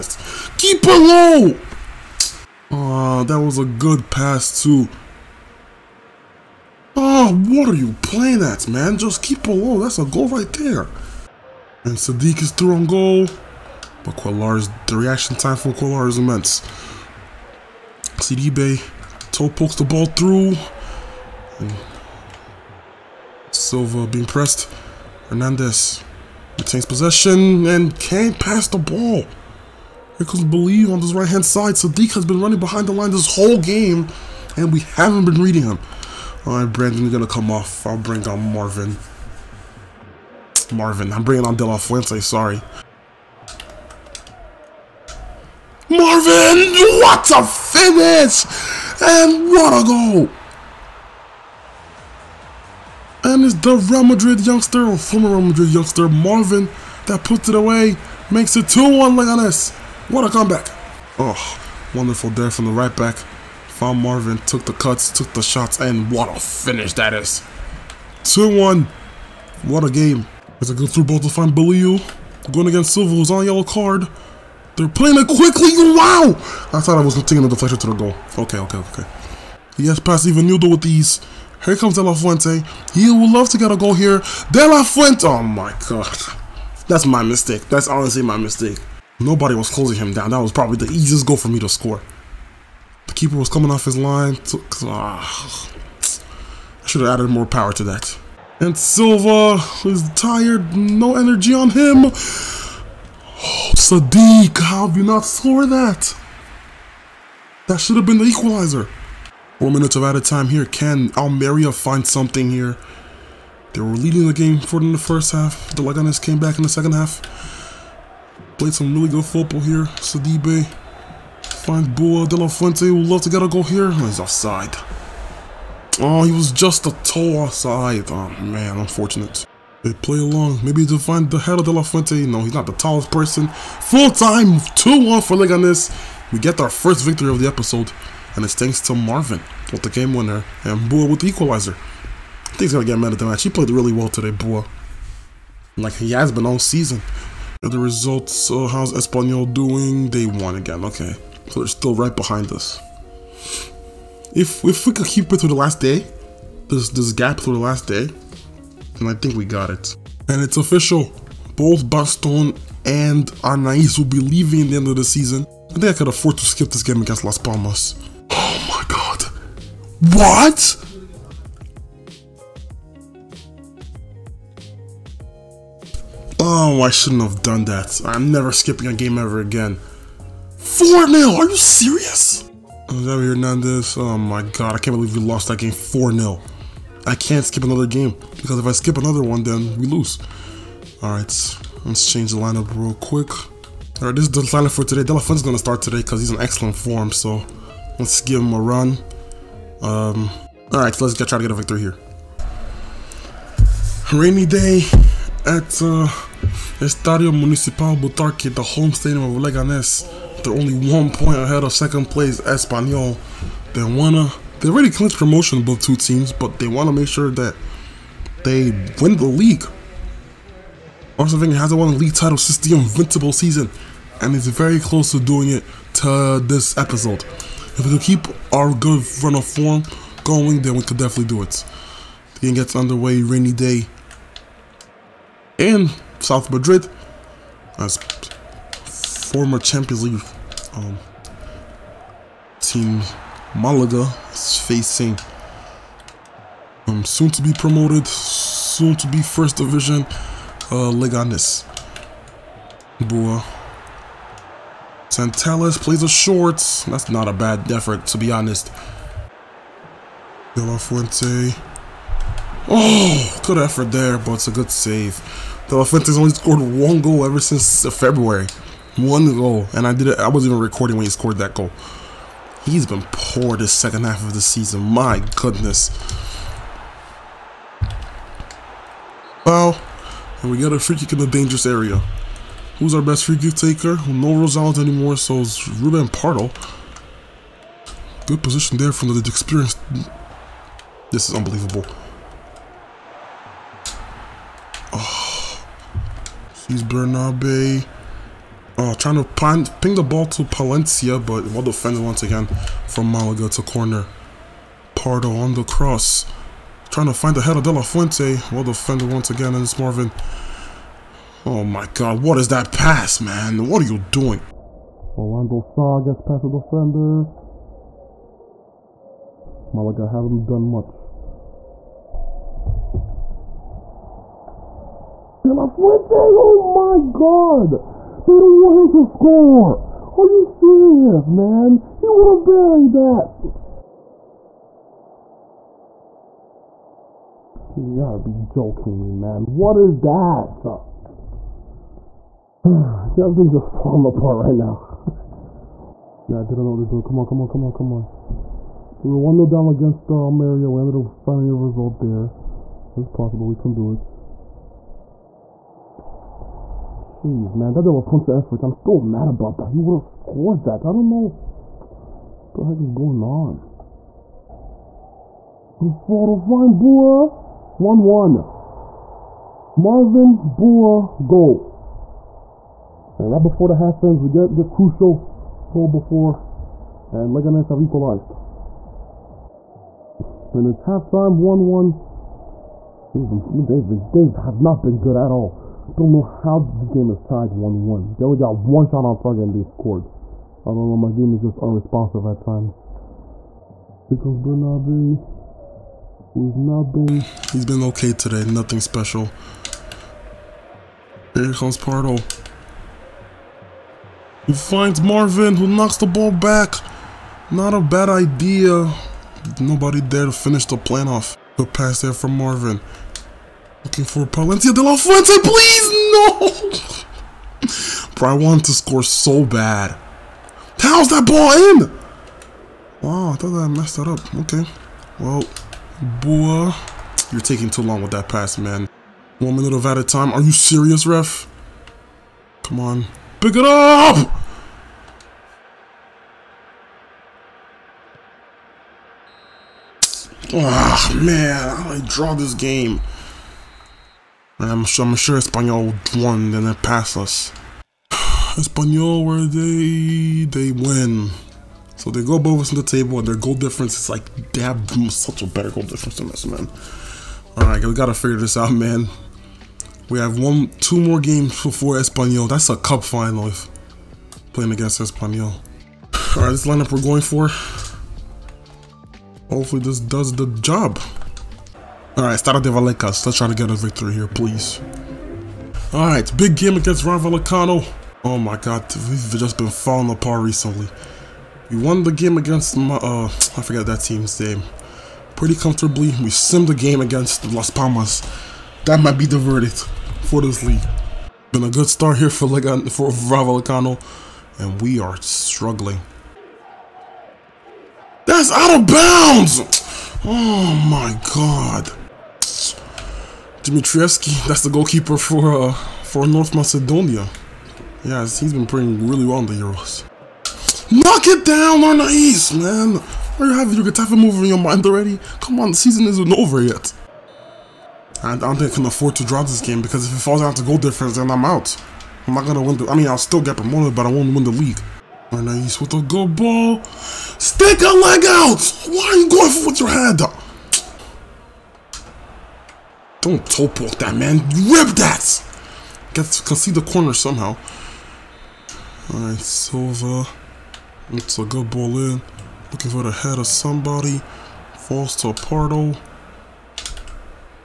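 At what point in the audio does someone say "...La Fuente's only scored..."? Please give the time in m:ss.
4:25.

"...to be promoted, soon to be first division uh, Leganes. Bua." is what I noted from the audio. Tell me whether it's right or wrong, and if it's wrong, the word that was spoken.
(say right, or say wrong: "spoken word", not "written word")
right.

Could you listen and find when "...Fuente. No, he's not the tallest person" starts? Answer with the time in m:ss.
2:11.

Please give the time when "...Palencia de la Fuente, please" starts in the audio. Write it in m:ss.
6:54.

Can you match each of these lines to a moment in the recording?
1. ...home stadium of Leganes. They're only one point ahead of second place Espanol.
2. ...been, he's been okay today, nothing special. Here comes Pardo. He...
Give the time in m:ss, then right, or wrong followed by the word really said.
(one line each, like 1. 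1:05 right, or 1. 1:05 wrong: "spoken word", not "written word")
1. 3:28 right
2. 6:36 right.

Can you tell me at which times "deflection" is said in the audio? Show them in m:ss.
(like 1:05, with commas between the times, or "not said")
1:17.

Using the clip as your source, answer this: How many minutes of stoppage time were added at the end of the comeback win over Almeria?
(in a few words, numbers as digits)
4.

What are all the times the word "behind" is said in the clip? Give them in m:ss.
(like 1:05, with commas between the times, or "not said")
0:32, 2:32.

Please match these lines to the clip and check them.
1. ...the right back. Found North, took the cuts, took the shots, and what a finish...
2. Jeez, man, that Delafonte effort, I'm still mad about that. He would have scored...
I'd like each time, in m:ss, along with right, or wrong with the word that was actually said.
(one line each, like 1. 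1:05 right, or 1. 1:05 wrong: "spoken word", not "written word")
1. 1:02 wrong: "Marvin", not "North"
2. 5:57 right.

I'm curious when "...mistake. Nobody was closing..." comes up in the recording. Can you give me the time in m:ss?
1:28.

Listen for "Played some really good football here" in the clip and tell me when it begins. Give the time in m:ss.
1:58.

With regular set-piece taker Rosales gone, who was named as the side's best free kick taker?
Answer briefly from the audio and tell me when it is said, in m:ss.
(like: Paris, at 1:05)
Ruben Pardo, at 4:45.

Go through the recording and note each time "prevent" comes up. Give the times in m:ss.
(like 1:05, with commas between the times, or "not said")
not said.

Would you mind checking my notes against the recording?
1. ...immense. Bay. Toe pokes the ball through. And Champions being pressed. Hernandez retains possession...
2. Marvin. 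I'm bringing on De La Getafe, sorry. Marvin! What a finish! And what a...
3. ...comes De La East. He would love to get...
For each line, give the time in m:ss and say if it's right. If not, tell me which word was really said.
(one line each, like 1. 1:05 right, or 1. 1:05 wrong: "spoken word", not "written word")
1. 0:16 wrong: "Silva", not "Champions"
2. 0:40 wrong: "Fuente", not "Getafe"
3. 1:21 wrong: "Fuente", not "East".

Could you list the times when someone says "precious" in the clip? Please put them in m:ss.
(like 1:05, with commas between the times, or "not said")
not said.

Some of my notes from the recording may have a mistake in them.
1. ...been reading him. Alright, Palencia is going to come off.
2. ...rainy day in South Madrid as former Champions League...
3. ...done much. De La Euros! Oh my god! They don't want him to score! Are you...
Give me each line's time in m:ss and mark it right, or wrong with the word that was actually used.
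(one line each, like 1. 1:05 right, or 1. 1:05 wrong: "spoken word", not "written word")
1. 0:35 wrong: "Brandon", not "Palencia"
2. 3:53 right
3. 5:20 wrong: "Fuente", not "Euros".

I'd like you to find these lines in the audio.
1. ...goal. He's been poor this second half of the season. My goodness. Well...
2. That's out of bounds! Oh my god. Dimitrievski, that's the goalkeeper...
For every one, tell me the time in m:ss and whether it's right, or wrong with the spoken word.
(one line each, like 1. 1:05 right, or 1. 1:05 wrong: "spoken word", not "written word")
1. 4:31 right
2. 8:18 right.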